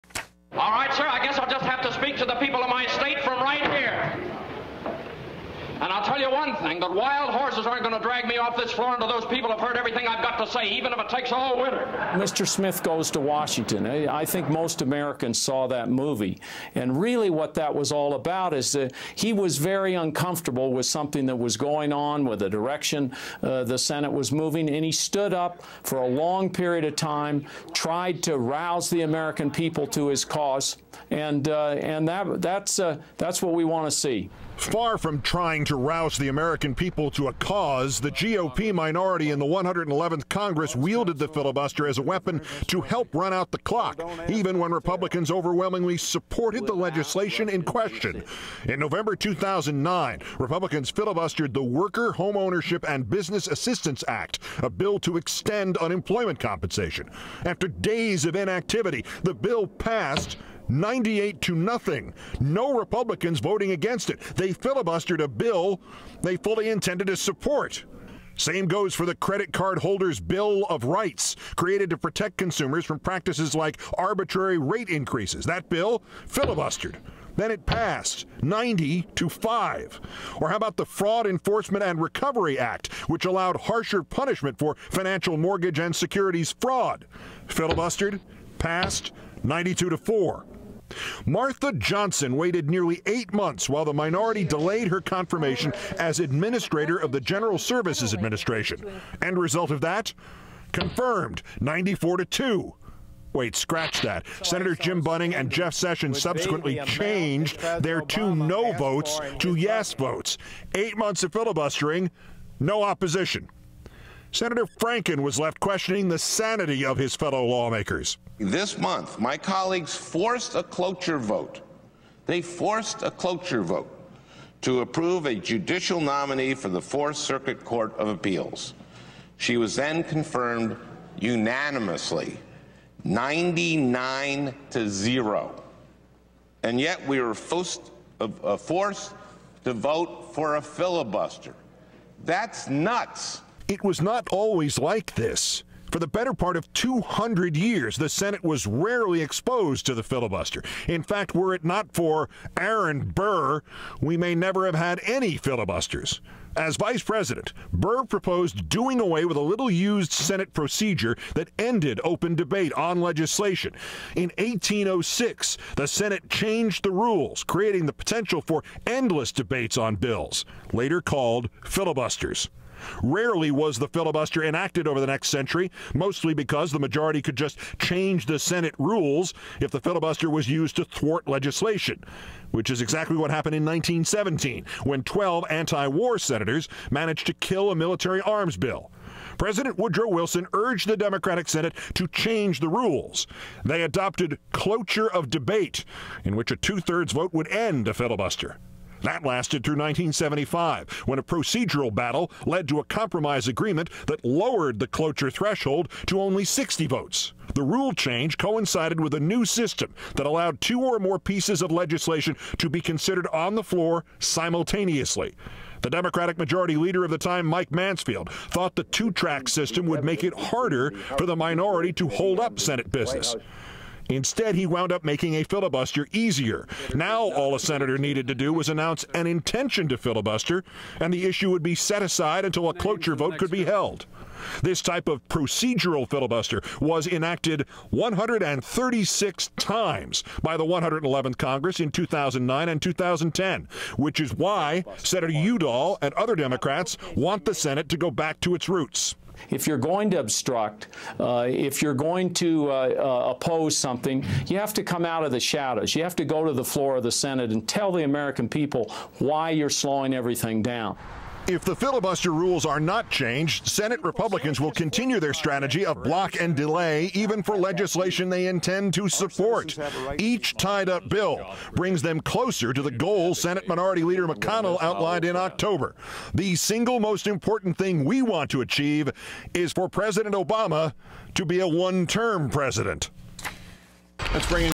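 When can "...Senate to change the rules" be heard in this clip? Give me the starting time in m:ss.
3:11.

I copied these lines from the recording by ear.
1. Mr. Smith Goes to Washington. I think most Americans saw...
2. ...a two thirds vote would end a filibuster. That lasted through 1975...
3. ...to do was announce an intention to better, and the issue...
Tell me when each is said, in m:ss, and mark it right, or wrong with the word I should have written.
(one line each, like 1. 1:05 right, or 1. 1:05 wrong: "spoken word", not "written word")
1. 0:12 right
2. 3:16 right
3. 3:48 wrong: "filibuster", not "better".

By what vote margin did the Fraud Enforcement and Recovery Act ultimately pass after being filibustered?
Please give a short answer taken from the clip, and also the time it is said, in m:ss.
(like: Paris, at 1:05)
92 to 4, at 1:29.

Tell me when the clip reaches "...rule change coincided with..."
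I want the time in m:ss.
3:27.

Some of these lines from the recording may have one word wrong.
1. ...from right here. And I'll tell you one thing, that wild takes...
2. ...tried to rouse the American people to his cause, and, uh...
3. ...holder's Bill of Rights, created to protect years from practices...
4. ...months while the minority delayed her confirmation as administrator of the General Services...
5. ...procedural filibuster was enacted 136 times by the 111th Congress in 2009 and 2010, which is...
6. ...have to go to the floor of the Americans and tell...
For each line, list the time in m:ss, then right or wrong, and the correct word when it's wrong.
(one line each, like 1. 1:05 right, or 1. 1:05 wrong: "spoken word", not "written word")
1. 0:03 wrong: "horses", not "takes"
2. 0:27 right
3. 1:09 wrong: "consumers", not "years"
4. 1:33 right
5. 3:55 right
6. 4:16 wrong: "Senate", not "Americans".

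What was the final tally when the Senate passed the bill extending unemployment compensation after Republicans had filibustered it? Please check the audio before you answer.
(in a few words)
98 to 0.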